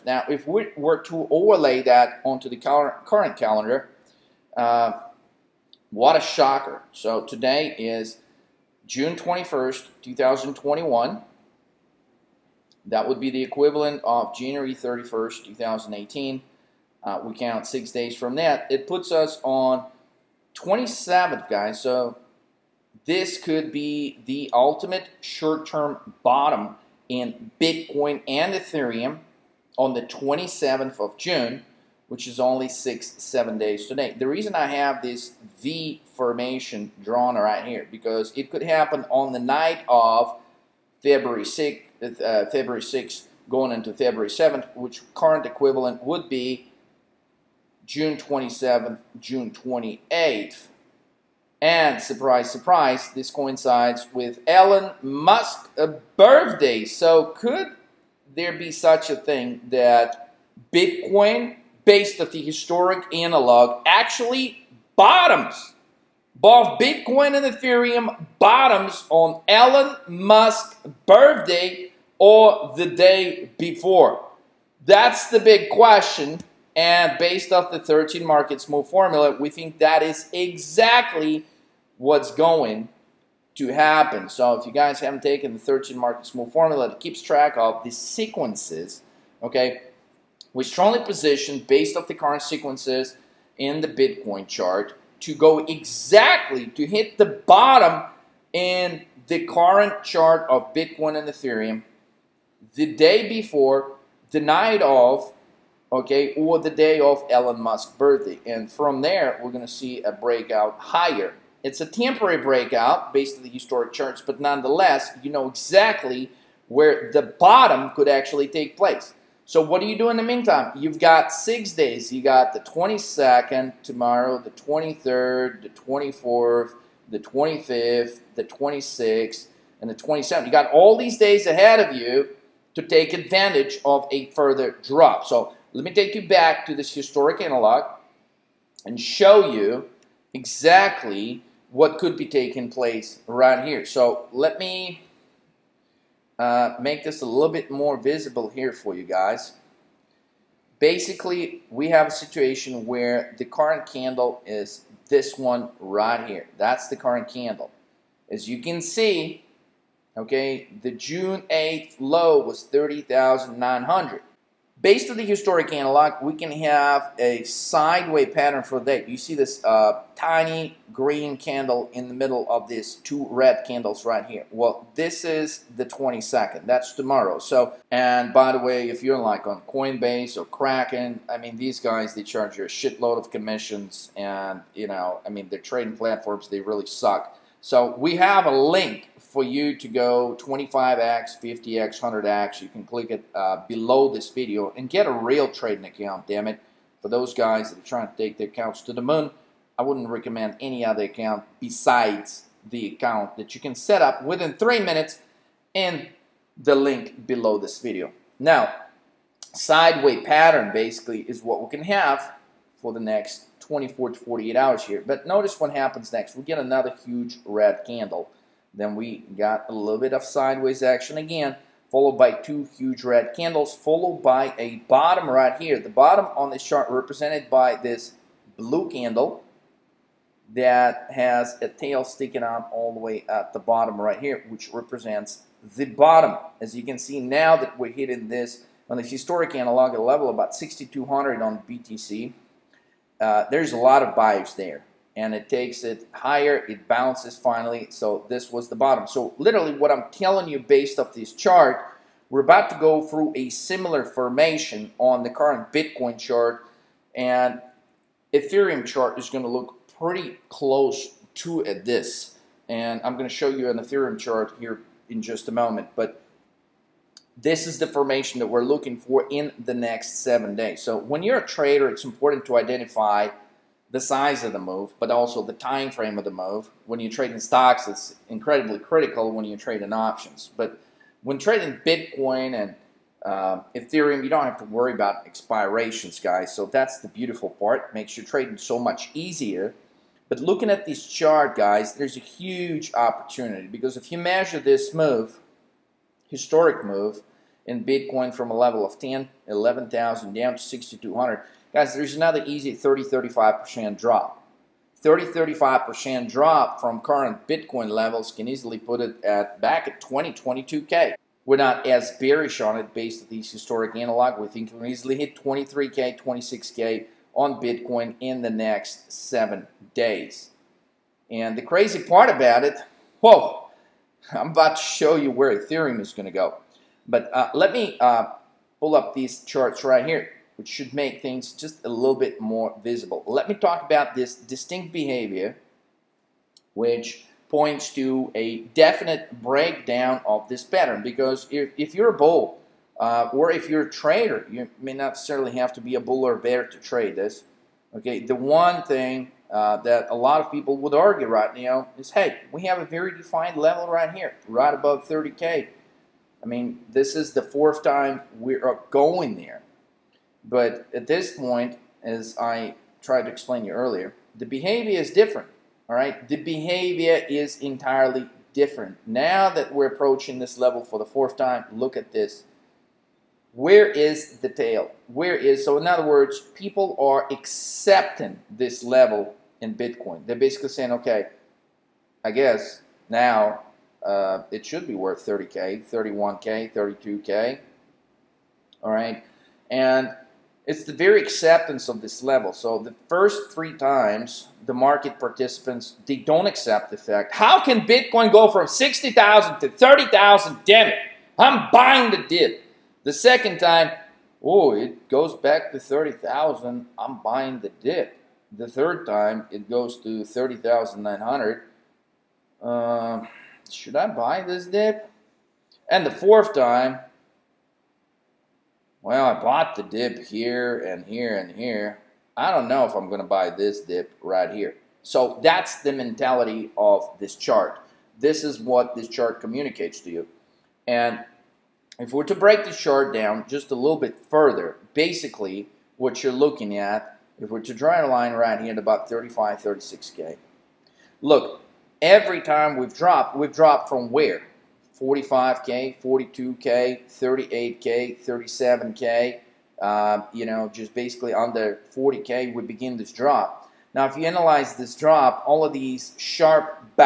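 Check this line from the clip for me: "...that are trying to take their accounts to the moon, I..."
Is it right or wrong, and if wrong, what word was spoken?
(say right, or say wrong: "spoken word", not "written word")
right.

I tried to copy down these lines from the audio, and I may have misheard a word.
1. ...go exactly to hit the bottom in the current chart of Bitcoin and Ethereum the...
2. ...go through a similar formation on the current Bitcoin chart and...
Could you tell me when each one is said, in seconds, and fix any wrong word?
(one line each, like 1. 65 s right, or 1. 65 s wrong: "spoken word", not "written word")
1. 95 s right
2. 252 s right.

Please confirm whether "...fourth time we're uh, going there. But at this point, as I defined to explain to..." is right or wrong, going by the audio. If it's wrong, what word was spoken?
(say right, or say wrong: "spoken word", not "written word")
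wrong: "tried", not "defined".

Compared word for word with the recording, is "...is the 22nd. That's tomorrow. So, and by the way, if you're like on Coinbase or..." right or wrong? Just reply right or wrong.
right.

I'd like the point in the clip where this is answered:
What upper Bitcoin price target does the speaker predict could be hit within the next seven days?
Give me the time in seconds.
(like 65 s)
316 s.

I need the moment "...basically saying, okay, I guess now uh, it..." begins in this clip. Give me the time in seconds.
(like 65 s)
380 s.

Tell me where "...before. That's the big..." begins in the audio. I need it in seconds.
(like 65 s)
73 s.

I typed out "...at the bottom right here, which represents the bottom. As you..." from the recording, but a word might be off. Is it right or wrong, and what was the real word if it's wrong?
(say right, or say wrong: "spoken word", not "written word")
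right.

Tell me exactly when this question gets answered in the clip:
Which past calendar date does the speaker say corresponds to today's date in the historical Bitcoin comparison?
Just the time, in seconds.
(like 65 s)
14 s.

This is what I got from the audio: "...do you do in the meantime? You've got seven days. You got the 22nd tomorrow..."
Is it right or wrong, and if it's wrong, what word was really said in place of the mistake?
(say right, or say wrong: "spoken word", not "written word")
wrong: "six", not "seven".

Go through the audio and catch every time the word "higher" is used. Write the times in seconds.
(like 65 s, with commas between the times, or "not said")
110 s, 246 s.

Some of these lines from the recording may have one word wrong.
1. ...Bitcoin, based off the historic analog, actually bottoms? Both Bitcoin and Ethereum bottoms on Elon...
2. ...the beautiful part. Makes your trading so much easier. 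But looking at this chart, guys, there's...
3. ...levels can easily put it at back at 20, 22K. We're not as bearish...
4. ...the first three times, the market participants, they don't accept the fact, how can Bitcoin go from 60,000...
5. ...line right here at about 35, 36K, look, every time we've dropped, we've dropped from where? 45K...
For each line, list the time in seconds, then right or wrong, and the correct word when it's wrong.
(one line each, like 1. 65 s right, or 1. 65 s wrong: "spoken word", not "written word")
1. 60 s right
2. 286 s right
3. 307 s right
4. 392 s right
5. 438 s right.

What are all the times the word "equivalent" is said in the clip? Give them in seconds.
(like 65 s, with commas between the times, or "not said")
13 s, 45 s.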